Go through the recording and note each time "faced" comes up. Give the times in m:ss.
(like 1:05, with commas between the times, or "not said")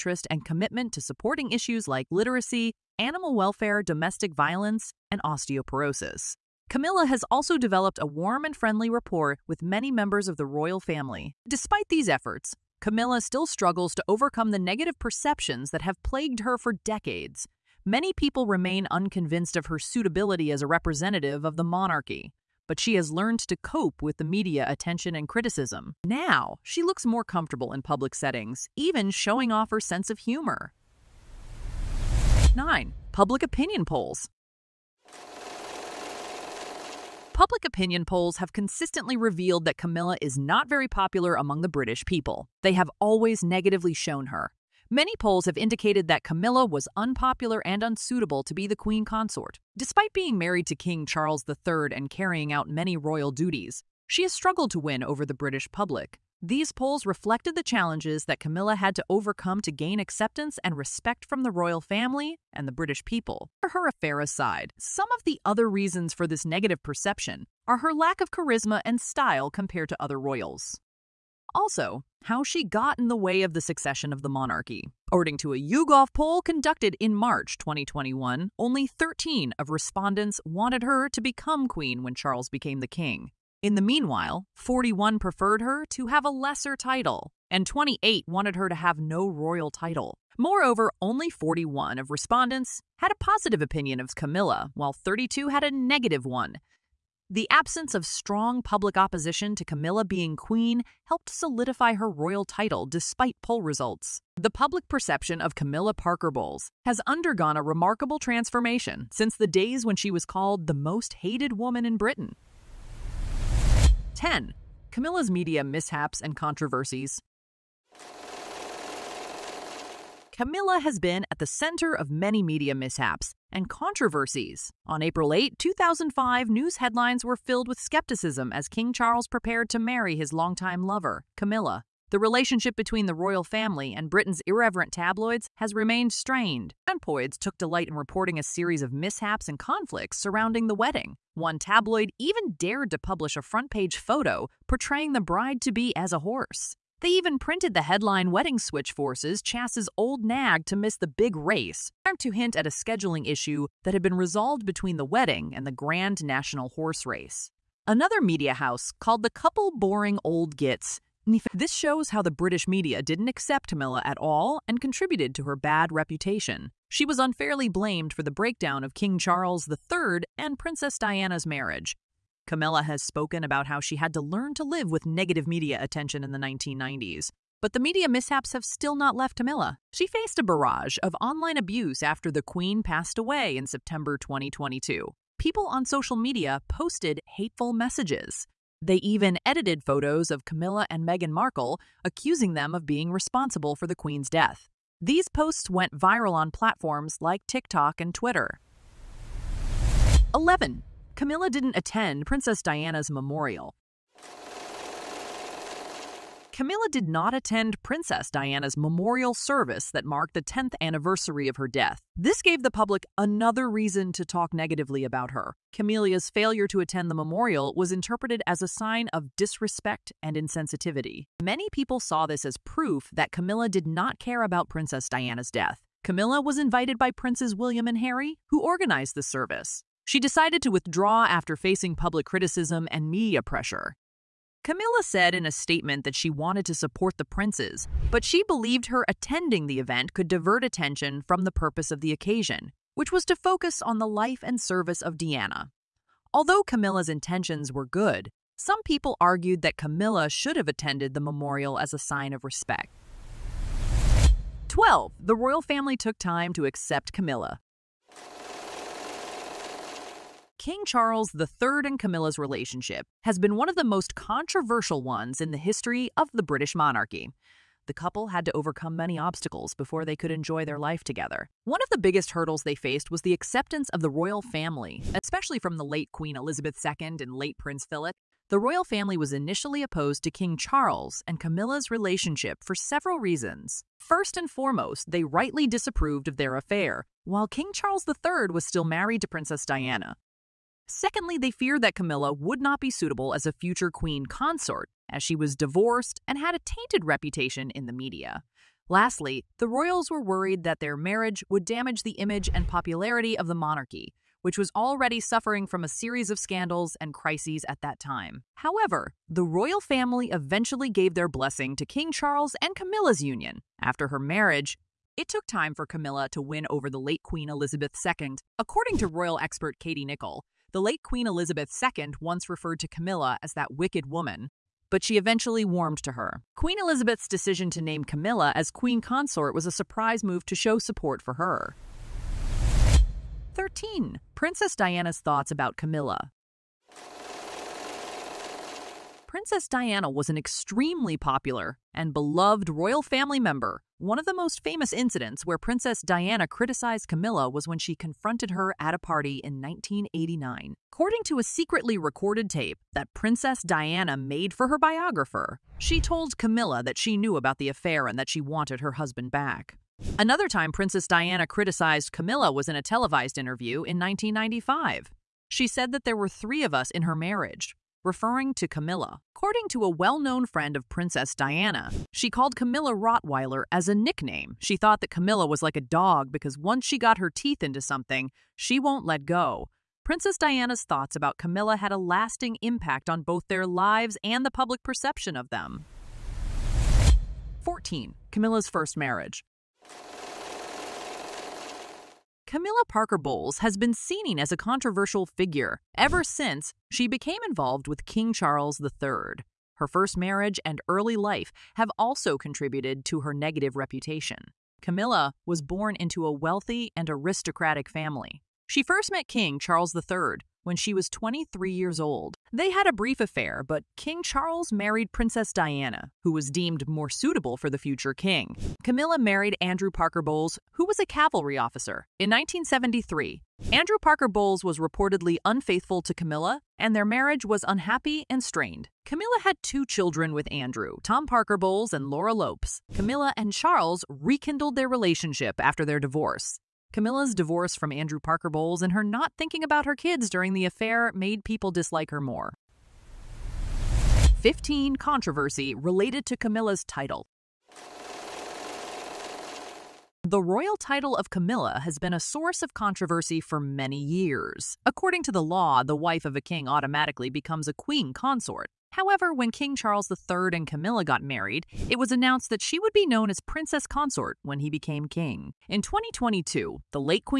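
3:00, 4:32.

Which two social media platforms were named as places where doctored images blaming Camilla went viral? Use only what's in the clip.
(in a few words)
TikTok and Twitter.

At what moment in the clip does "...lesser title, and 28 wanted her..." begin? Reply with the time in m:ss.
1:26.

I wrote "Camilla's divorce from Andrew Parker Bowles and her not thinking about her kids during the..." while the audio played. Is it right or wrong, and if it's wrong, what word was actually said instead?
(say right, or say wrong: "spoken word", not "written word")
right.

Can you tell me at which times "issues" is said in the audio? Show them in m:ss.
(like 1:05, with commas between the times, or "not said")
0:01, 2:33.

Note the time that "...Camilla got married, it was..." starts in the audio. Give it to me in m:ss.
7:40.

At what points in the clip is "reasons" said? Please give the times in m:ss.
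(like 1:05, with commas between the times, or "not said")
1:05, 3:33, 4:43.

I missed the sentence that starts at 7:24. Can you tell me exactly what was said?
15 Controversy related to Camilla's title.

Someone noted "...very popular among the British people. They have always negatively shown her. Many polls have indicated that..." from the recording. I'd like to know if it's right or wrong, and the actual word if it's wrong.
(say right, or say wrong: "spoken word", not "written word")
right.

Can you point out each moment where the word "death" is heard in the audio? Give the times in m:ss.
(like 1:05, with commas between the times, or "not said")
3:14, 3:31, 3:45.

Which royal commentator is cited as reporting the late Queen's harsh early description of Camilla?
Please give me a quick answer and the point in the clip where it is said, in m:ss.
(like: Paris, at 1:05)
Katie Nicholl, at 5:19.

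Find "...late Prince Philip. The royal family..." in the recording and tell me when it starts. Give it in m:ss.
4:37.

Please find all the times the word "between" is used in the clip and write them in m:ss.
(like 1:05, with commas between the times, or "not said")
2:12, 2:34.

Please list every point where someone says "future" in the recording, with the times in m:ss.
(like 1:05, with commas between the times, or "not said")
4:53, 6:57.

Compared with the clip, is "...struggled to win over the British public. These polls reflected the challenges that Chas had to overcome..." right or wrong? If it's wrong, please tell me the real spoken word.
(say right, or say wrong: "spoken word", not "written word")
wrong: "Camilla", not "Chas".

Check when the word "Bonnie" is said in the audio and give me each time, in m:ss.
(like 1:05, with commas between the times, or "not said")
not said.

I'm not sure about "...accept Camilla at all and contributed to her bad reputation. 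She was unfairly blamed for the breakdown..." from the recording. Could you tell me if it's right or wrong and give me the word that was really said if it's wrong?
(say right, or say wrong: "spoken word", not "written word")
right.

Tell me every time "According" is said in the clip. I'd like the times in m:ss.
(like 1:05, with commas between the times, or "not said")
1:15, 5:18, 5:50, 6:09, 7:34.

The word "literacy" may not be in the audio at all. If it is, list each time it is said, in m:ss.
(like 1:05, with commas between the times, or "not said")
0:02.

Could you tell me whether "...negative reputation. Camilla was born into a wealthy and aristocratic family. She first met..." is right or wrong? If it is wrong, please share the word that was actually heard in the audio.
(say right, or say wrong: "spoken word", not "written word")
right.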